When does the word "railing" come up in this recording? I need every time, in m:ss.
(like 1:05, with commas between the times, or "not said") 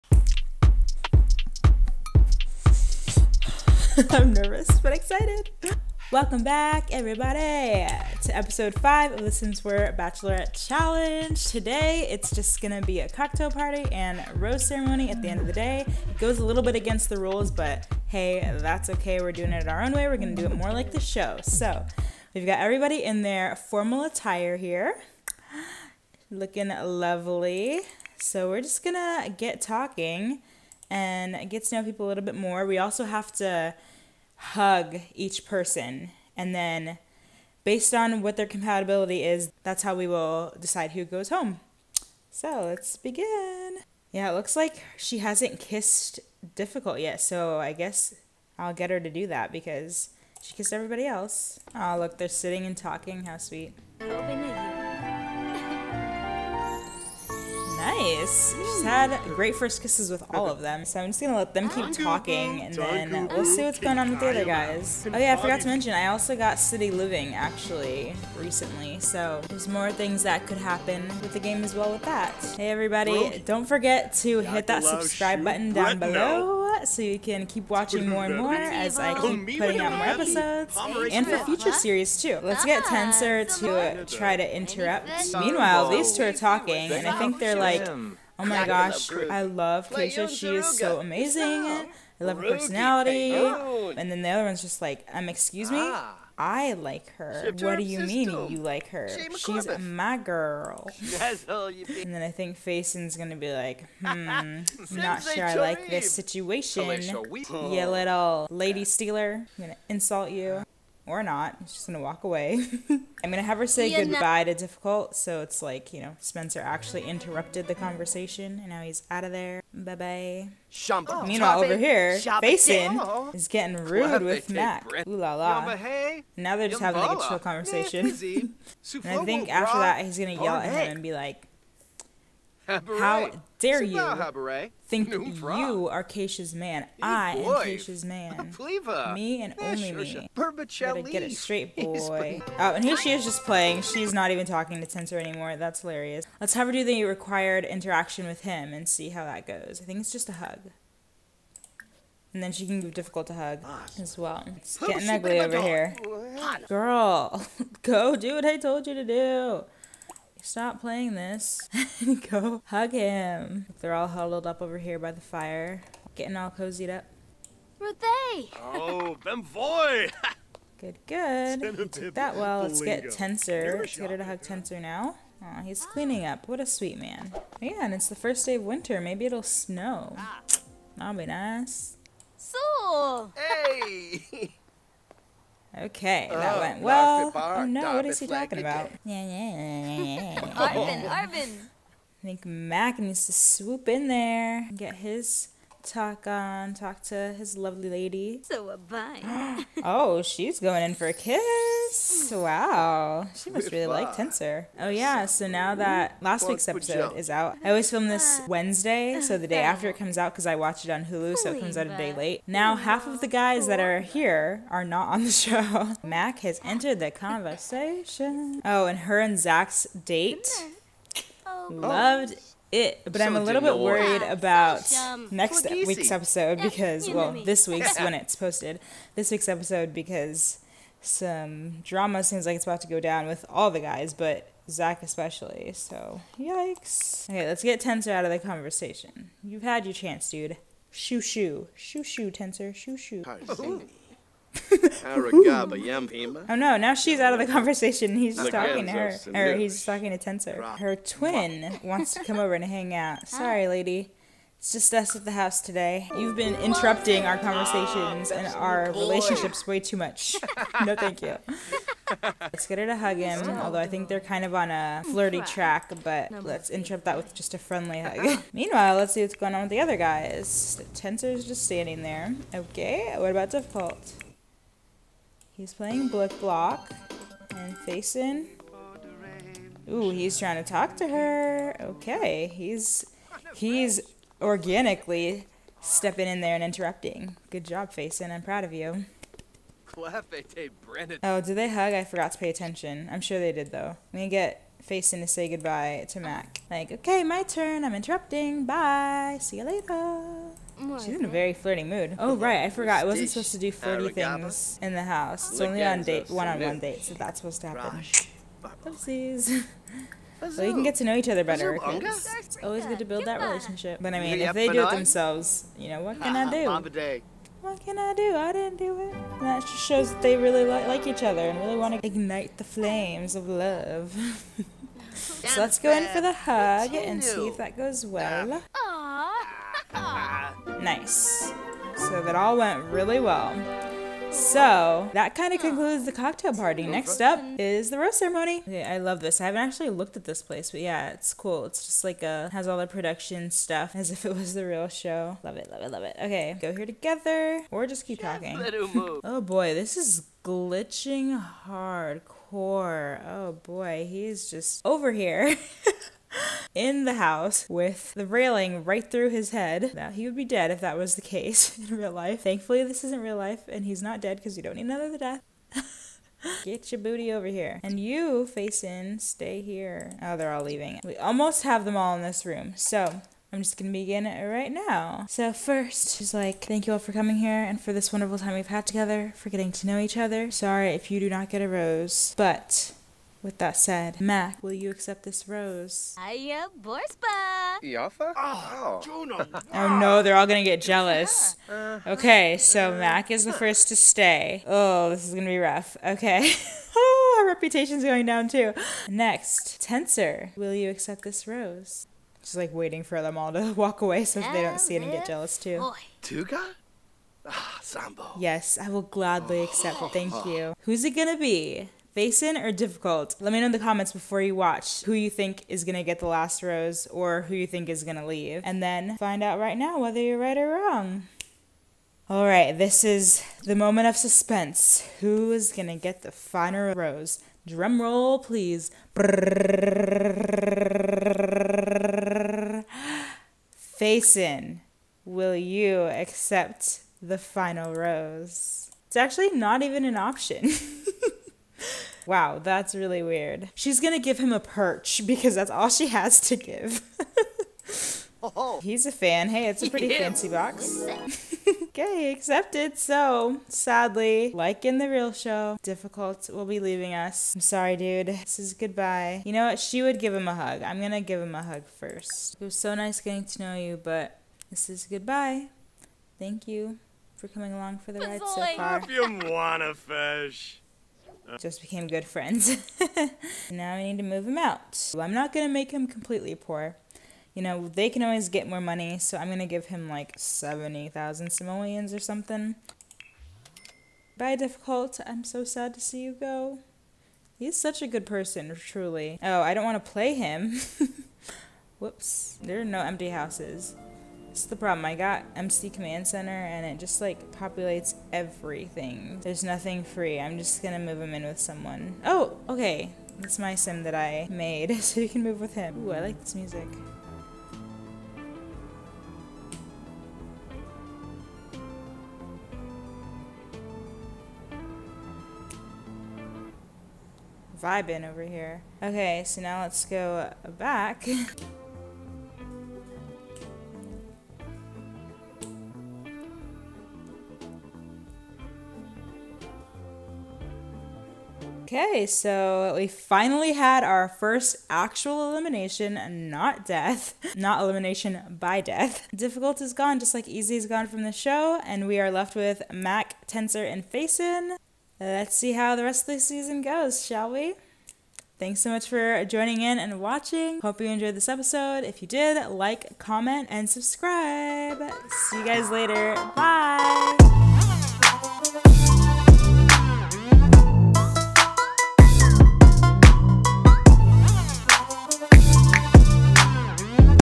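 5:58.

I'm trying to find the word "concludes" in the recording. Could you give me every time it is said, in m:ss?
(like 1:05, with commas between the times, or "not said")
5:35.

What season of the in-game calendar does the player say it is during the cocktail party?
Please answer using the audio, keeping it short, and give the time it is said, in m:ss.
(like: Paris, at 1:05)
winter, at 2:58.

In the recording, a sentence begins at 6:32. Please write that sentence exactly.
Mac is the first to stay.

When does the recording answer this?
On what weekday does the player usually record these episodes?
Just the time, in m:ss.
3:28.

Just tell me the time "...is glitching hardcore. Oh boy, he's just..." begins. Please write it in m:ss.
5:49.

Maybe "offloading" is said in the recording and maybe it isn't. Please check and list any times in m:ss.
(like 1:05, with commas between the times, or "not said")
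not said.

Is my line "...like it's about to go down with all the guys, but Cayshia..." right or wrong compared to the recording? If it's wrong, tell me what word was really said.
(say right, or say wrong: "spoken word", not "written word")
wrong: "Zac", not "Cayshia".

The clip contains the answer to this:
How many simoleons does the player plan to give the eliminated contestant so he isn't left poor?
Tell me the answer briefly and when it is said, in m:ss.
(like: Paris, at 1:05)
70,000, at 8:00.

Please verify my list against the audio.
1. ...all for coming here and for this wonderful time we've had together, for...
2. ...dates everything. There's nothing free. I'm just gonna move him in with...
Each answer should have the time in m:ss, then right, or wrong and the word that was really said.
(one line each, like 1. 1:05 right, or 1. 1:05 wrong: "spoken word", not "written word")
1. 6:16 right
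2. 8:17 wrong: "populates", not "dates".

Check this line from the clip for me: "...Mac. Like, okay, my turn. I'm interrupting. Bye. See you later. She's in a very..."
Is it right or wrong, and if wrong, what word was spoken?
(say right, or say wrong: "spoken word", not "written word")
right.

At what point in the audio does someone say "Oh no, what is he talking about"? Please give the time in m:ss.
3:07.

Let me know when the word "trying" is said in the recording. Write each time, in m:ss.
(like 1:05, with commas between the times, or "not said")
4:40.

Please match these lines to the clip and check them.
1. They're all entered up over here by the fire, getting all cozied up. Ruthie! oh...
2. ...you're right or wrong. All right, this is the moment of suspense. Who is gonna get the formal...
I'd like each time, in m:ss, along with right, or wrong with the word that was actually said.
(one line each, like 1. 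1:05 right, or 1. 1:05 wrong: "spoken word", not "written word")
1. 2:43 wrong: "huddled", not "entered"
2. 7:00 wrong: "final", not "formal".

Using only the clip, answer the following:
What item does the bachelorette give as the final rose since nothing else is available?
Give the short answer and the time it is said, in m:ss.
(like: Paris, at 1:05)
a perch, at 7:24.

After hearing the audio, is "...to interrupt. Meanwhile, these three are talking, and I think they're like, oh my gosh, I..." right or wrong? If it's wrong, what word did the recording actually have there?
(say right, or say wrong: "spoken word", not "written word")
wrong: "two", not "three".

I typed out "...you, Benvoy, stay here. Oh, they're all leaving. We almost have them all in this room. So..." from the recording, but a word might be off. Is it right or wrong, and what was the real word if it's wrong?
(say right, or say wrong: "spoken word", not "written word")
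wrong: "Faison", not "Benvoy".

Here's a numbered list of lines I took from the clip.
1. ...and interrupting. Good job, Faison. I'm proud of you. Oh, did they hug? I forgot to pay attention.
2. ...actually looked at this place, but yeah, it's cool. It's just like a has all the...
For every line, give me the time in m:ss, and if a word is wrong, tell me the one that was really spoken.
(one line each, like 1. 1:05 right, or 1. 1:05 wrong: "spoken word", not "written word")
1. 4:46 right
2. 5:39 right.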